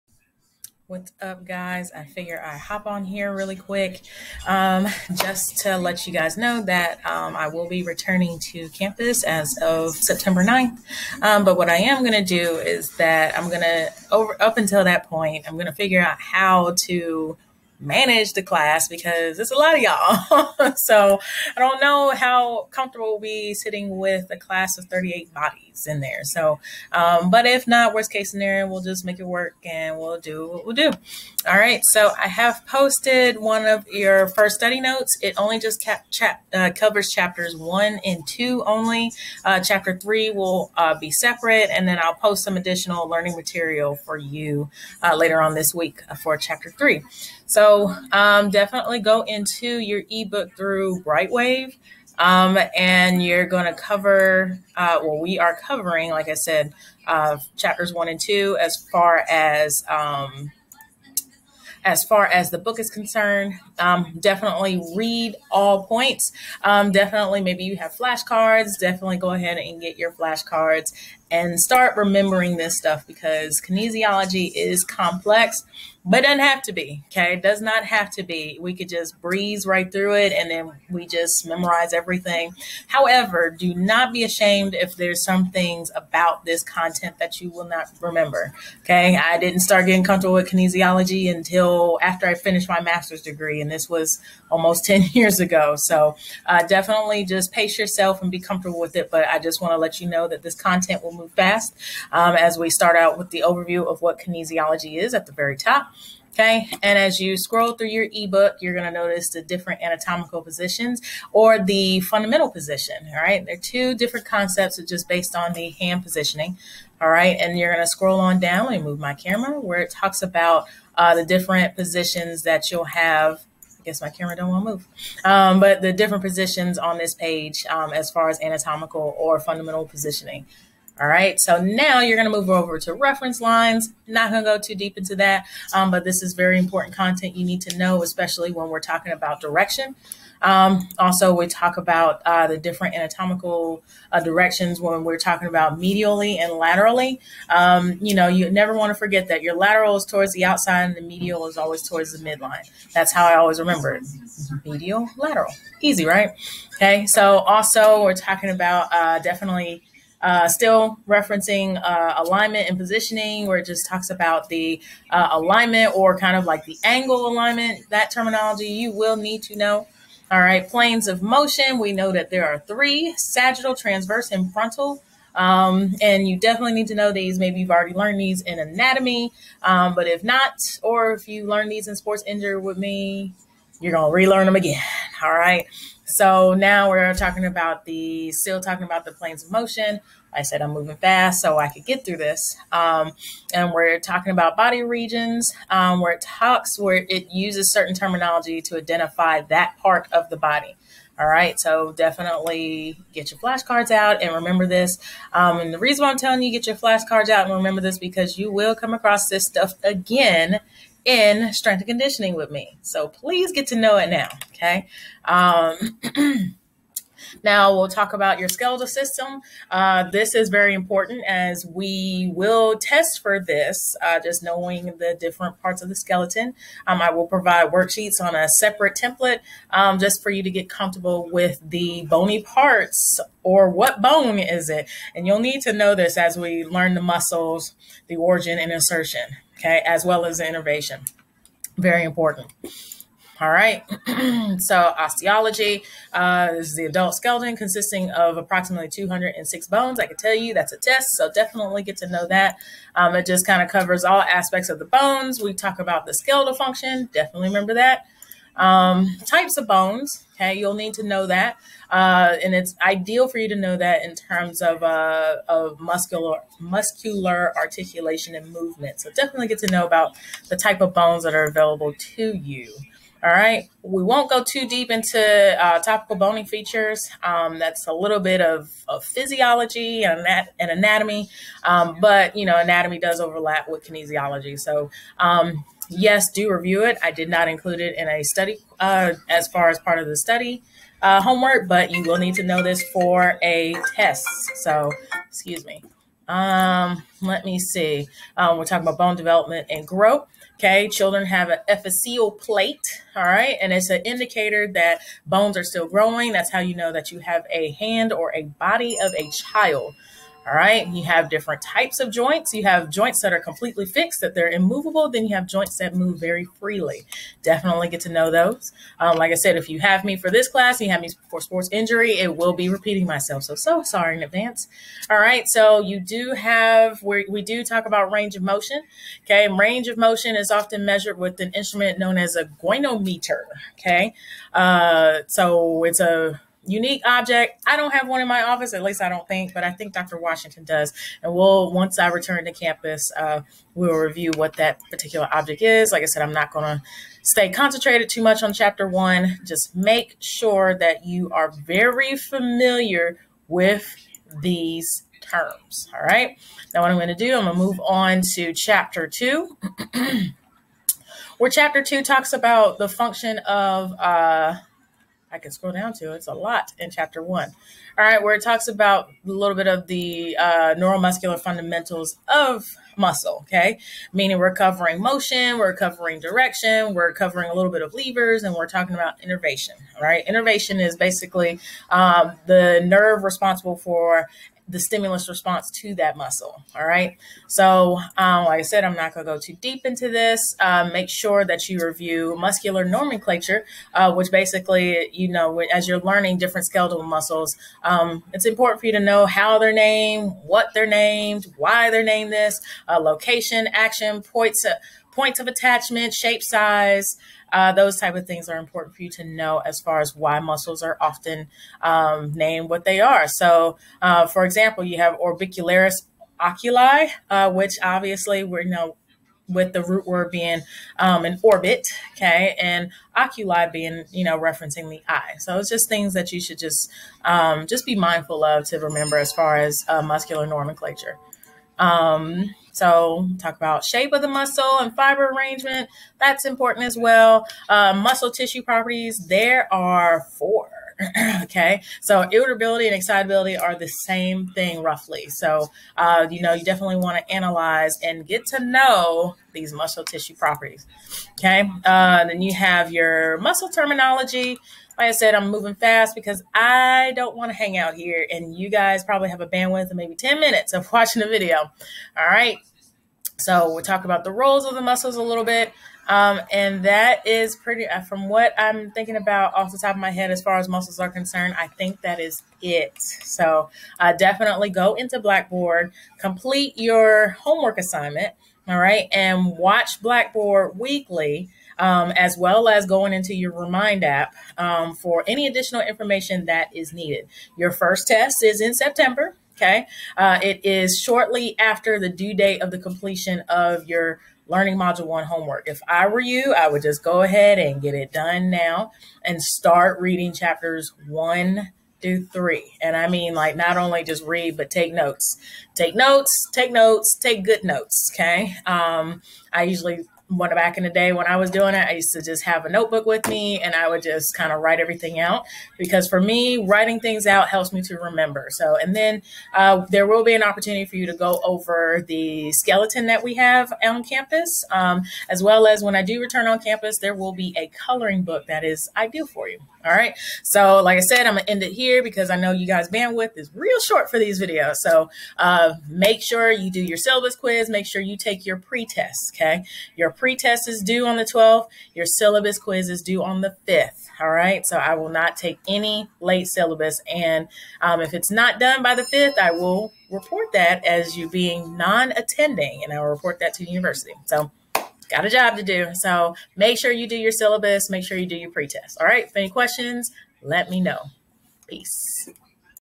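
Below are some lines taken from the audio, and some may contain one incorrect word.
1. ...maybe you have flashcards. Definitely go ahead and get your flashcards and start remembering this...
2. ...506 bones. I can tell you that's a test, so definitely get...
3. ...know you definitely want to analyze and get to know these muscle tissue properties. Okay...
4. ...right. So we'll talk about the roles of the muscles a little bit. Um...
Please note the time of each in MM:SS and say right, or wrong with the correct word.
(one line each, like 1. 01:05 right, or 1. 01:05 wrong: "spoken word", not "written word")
1. 01:07 right
2. 04:08 wrong: "206", not "506"
3. 07:26 right
4. 07:42 right.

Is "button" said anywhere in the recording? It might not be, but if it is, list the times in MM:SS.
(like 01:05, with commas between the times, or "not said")
not said.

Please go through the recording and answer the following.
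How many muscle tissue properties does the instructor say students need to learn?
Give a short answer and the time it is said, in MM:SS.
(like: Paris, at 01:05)
4, at 07:20.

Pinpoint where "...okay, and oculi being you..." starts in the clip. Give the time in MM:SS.
07:02.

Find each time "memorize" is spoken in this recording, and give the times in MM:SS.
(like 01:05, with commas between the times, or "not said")
01:21.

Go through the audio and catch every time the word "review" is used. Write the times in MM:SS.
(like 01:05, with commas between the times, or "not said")
04:46, 05:43, 06:31.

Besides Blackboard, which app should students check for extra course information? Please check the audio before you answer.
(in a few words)
Remind.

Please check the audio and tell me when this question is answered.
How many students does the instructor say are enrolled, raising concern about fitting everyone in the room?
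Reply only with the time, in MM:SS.
00:24.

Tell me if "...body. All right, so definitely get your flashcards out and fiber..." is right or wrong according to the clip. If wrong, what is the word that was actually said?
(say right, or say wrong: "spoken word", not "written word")
wrong: "remember", not "fiber".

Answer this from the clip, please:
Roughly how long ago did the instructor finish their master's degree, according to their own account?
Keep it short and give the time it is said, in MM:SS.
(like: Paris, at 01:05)
ten years, at 01:34.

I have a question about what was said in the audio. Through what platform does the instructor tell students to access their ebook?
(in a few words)
Brightwave.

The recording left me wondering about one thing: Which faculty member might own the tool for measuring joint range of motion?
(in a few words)
Dr. Washington.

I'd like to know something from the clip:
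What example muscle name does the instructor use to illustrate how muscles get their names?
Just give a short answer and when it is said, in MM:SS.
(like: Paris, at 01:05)
orbicularis oculi, at 06:55.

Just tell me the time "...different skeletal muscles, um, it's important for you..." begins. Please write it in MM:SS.
06:36.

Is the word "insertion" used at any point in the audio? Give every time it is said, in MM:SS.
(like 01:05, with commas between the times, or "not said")
03:58.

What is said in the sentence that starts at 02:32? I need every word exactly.
That's how I always remember it.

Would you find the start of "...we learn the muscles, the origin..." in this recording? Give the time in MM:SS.
03:56.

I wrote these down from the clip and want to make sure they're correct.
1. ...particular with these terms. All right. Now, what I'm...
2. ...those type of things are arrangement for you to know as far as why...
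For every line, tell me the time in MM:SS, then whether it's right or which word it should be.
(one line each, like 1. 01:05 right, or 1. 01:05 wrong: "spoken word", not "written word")
1. 05:52 wrong: "familiar", not "particular"
2. 06:47 wrong: "important", not "arrangement".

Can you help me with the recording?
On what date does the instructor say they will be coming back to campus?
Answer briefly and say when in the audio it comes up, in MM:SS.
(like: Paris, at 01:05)
September 9th, at 00:09.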